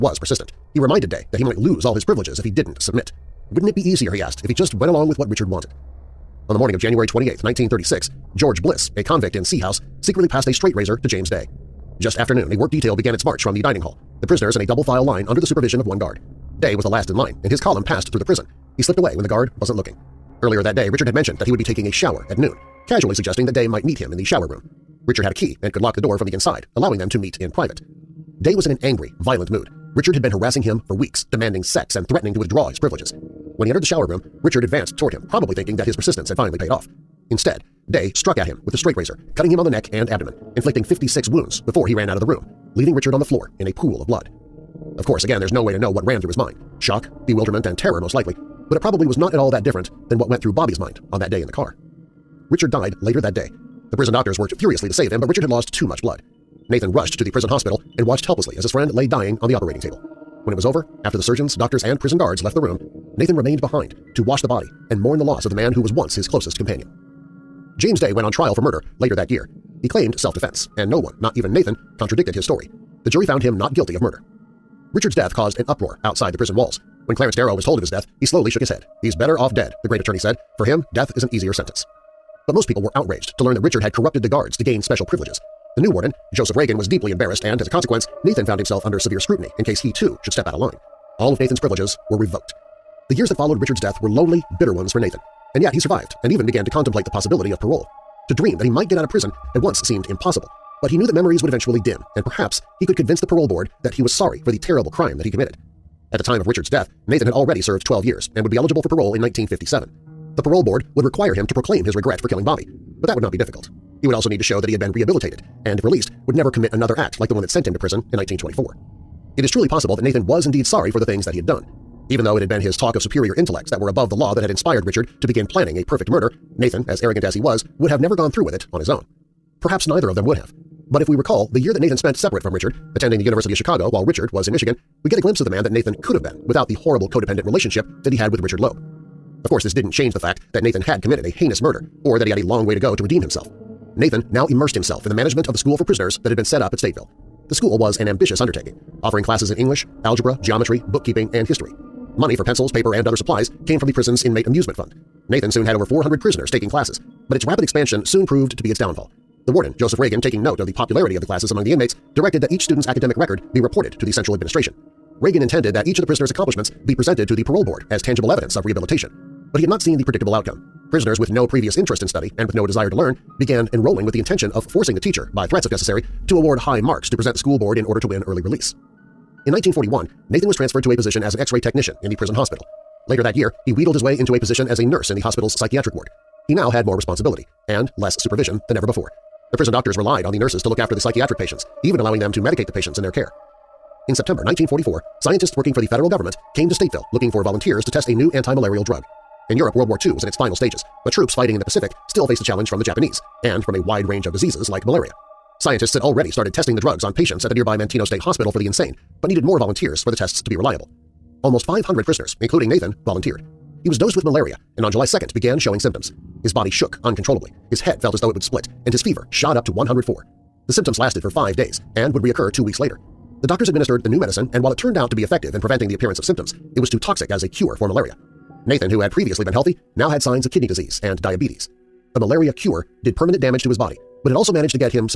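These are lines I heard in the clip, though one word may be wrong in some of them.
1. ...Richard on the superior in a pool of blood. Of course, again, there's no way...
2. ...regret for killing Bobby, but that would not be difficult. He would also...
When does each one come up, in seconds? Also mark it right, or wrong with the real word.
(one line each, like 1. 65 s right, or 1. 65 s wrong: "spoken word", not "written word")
1. 42 s wrong: "floor", not "superior"
2. 111 s right.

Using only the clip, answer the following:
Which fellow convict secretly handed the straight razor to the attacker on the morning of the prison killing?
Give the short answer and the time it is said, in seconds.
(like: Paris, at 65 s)
George Bliss, at 8 s.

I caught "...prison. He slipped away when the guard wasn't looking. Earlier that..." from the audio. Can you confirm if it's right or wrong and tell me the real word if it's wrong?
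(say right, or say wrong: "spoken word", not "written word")
right.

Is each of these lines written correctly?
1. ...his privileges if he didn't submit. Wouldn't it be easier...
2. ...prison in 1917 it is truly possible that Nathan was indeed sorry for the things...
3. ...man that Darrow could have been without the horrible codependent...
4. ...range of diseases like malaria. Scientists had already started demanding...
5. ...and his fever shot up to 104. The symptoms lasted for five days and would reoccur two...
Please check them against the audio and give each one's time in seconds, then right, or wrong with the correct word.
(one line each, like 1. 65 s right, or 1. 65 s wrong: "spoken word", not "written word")
1. 1 s right
2. 117 s wrong: "1924", not "1917"
3. 135 s wrong: "Nathan", not "Darrow"
4. 204 s wrong: "testing", not "demanding"
5. 218 s right.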